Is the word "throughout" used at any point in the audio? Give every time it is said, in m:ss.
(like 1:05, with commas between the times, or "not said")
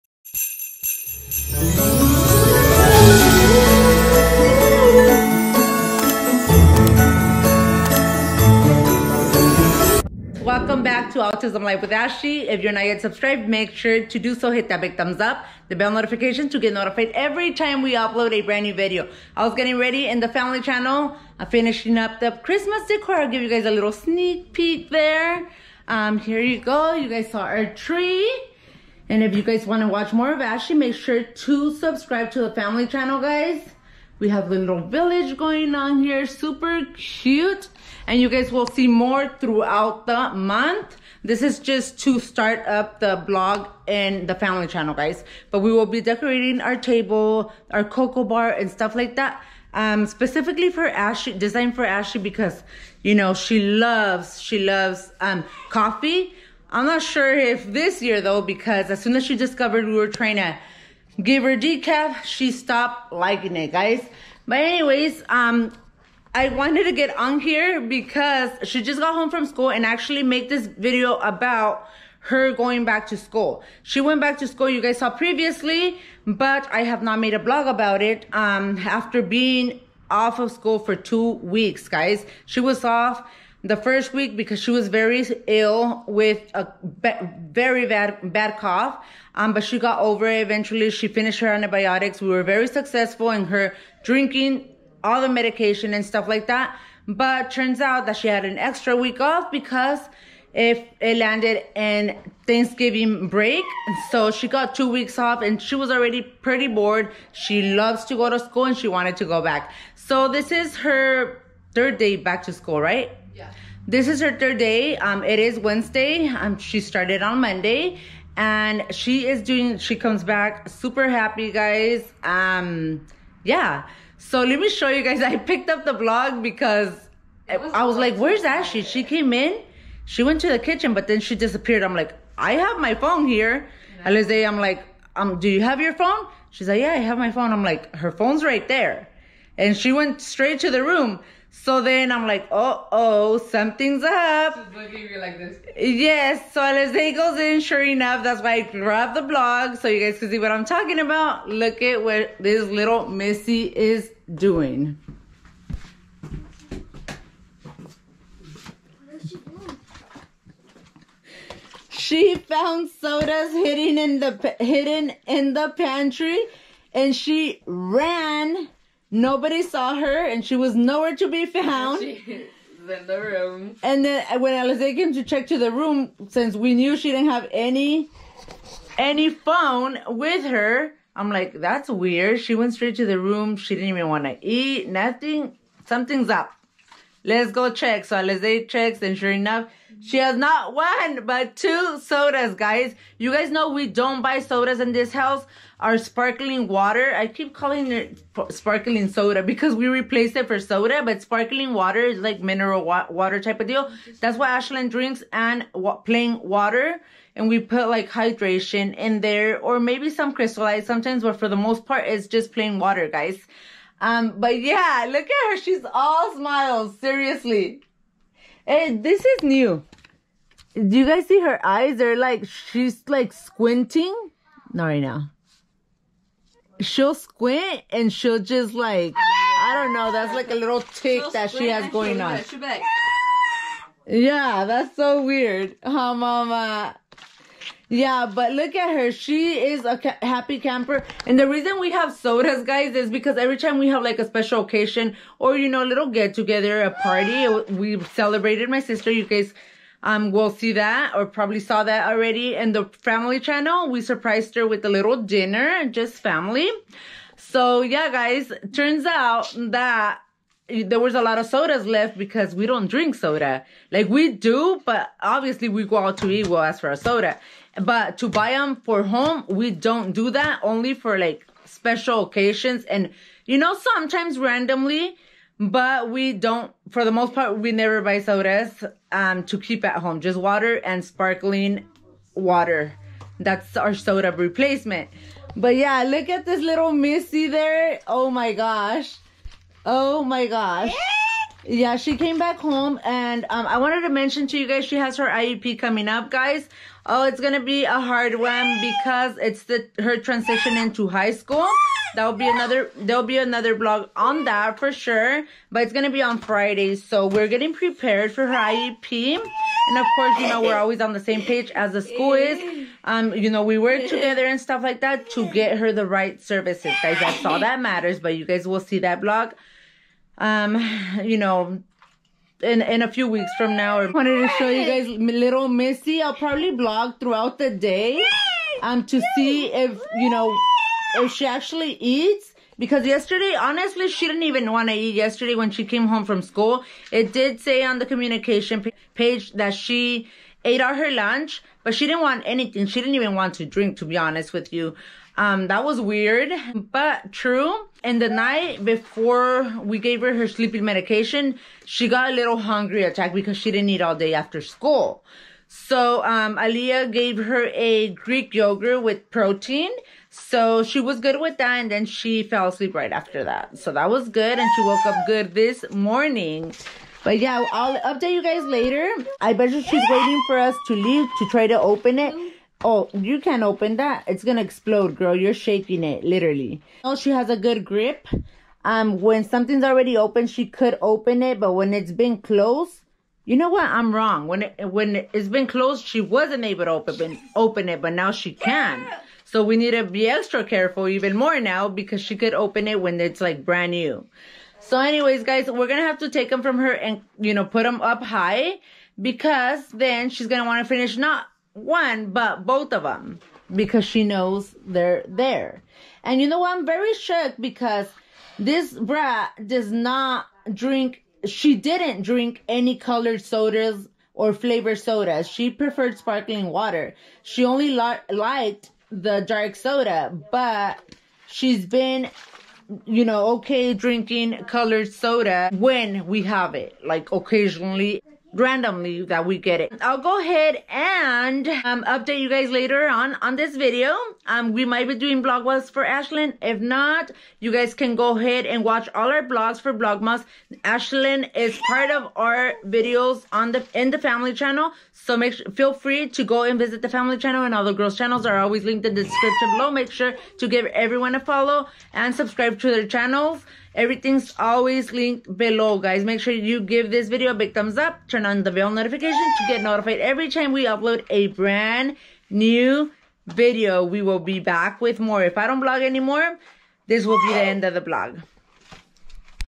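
0:39, 5:27.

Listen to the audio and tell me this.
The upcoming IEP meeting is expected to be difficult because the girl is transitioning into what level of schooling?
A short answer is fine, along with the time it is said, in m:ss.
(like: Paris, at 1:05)
high school, at 5:01.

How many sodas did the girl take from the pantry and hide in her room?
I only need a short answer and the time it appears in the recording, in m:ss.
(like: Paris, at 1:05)
2, at 3:11.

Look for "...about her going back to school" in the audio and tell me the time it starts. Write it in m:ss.
1:11.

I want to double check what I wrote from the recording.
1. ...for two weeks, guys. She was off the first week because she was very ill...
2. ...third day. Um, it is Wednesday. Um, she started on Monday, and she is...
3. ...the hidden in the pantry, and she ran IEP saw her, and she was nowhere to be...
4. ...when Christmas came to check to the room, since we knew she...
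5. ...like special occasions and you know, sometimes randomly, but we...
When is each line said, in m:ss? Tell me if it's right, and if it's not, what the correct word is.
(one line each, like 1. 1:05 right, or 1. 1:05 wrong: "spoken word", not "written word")
1. 1:20 right
2. 1:54 right
3. 2:44 wrong: "Nobody", not "IEP"
4. 2:54 wrong: "Alizé", not "Christmas"
5. 4:31 right.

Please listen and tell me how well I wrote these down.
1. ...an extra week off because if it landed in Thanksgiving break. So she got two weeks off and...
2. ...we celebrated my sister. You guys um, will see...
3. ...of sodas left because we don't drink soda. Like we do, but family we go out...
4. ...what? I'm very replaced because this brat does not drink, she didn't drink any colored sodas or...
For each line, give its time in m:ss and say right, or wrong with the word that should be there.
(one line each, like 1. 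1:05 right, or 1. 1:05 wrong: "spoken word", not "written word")
1. 1:38 right
2. 4:07 right
3. 4:21 wrong: "obviously", not "family"
4. 6:46 wrong: "shocked", not "replaced".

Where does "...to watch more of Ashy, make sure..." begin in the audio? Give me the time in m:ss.
0:29.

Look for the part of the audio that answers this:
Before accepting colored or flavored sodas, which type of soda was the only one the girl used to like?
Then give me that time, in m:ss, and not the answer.
6:59.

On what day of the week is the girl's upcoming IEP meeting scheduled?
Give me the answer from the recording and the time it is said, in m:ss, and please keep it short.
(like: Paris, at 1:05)
Friday, at 5:06.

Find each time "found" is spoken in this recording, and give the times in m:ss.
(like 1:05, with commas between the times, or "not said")
2:42, 2:51.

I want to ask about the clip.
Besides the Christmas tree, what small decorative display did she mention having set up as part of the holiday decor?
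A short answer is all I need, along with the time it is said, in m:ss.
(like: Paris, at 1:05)
little village, at 0:34.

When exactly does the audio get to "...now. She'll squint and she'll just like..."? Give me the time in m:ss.
3:45.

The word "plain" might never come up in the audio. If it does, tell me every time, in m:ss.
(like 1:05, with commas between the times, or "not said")
3:25, 3:32.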